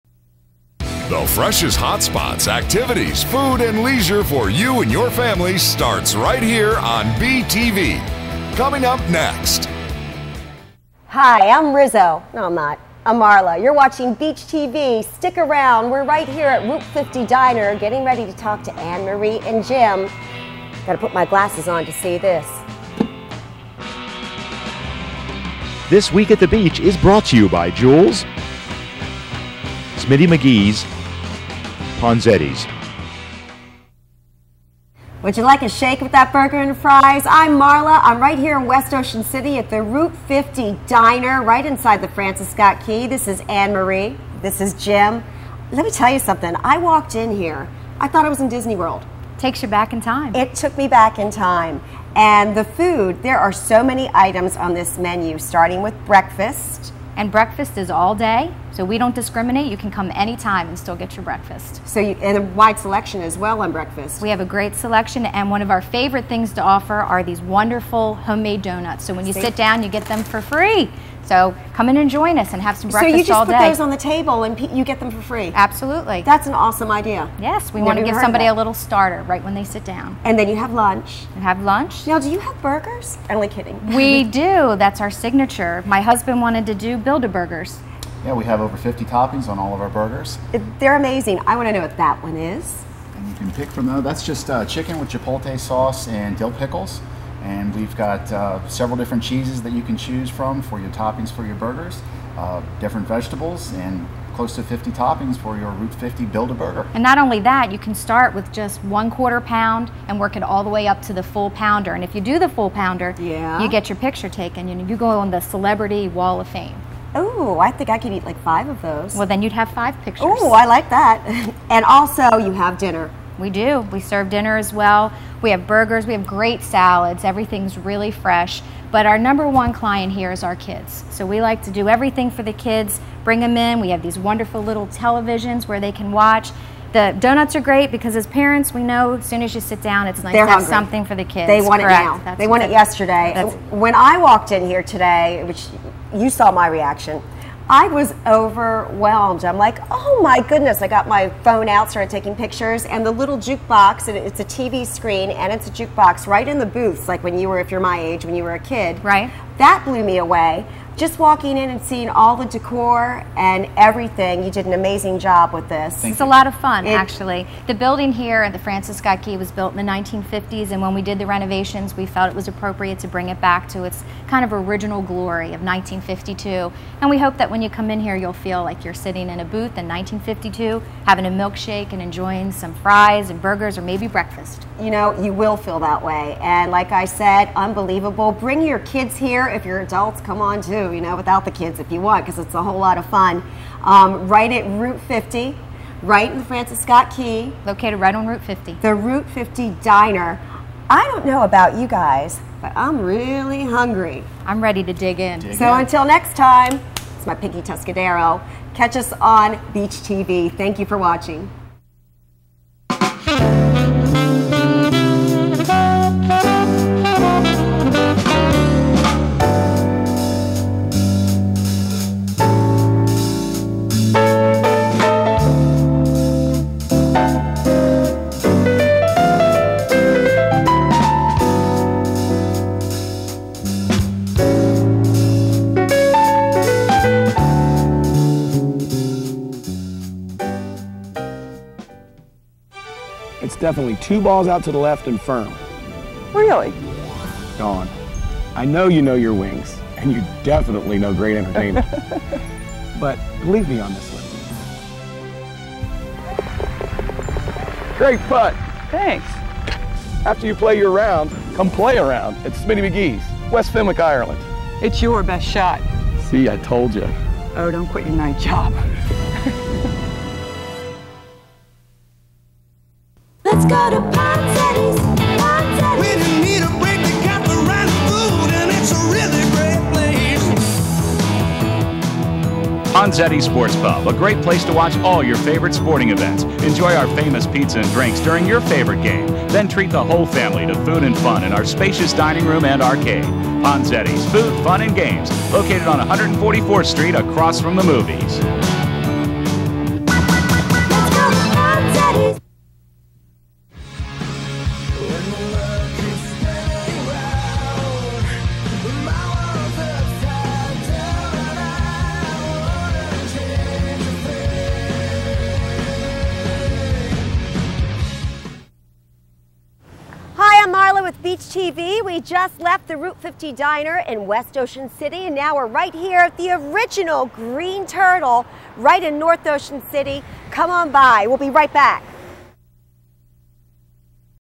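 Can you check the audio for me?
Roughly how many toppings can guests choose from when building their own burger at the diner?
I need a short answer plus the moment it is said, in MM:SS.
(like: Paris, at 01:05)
50, at 01:28.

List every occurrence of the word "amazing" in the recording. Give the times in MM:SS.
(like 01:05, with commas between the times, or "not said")
01:30, 02:44.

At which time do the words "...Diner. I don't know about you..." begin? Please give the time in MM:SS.
03:19.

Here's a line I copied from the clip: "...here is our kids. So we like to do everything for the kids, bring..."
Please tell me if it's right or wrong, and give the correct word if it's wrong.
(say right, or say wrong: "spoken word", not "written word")
right.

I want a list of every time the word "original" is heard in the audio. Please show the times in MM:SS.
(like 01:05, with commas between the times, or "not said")
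02:54, 05:26.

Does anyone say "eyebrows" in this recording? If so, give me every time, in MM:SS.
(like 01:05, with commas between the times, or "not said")
not said.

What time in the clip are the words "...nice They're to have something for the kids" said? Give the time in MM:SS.
02:20.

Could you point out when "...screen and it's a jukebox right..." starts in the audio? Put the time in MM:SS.
02:34.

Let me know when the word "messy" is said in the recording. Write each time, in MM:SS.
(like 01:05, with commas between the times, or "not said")
not said.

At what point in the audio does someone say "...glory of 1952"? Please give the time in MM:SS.
02:55.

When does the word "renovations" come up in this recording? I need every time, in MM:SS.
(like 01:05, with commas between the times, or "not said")
02:51.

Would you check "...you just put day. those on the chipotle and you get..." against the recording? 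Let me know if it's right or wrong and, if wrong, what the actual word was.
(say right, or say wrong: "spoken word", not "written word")
wrong: "table", not "chipotle".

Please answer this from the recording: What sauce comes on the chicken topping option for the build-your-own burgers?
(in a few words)
chipotle sauce.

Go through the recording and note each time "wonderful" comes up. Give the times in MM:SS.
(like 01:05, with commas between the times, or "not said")
01:07, 02:14.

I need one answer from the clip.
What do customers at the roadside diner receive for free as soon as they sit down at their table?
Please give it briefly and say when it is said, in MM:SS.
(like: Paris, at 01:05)
homemade donuts, at 01:08.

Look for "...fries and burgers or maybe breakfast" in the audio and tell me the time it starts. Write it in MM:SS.
03:02.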